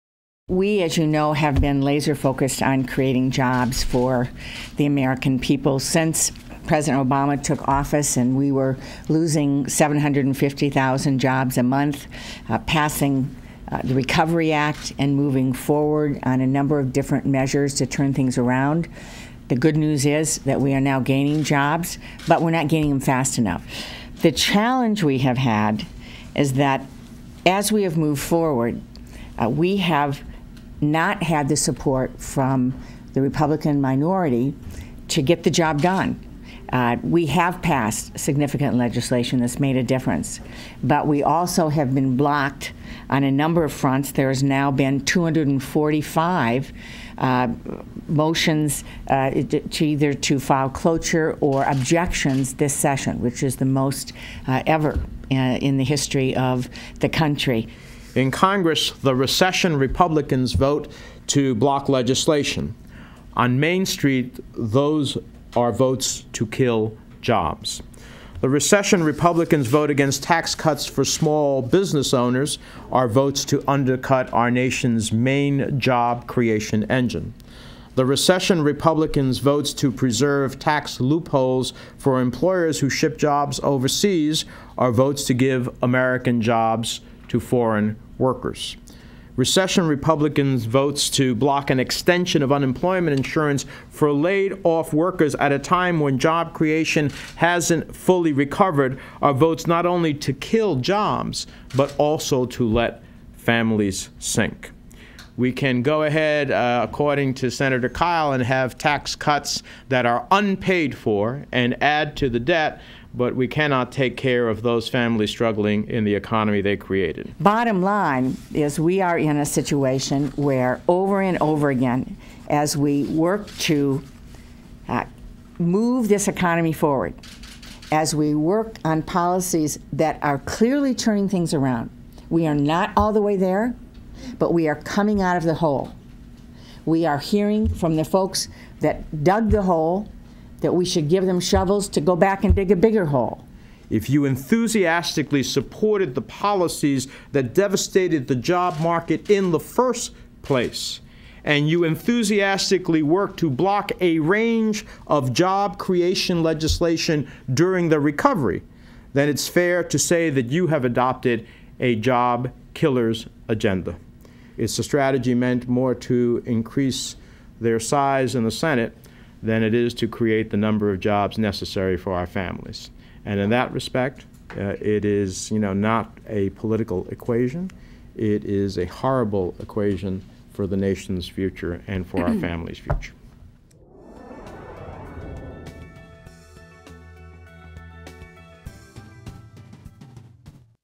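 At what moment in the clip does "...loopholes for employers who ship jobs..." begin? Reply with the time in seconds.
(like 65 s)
80 s.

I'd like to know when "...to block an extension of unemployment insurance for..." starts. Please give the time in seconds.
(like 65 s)
91 s.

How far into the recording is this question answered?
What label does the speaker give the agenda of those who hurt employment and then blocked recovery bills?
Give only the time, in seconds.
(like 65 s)
161 s.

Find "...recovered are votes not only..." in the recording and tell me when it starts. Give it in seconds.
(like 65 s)
98 s.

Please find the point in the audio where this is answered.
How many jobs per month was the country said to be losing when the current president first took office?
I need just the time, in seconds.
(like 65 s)
9 s.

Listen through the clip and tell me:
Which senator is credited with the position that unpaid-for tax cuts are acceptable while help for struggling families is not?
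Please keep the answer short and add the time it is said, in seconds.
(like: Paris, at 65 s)
Senator Kyl, at 107 s.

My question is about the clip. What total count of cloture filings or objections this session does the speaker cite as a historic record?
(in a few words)
245.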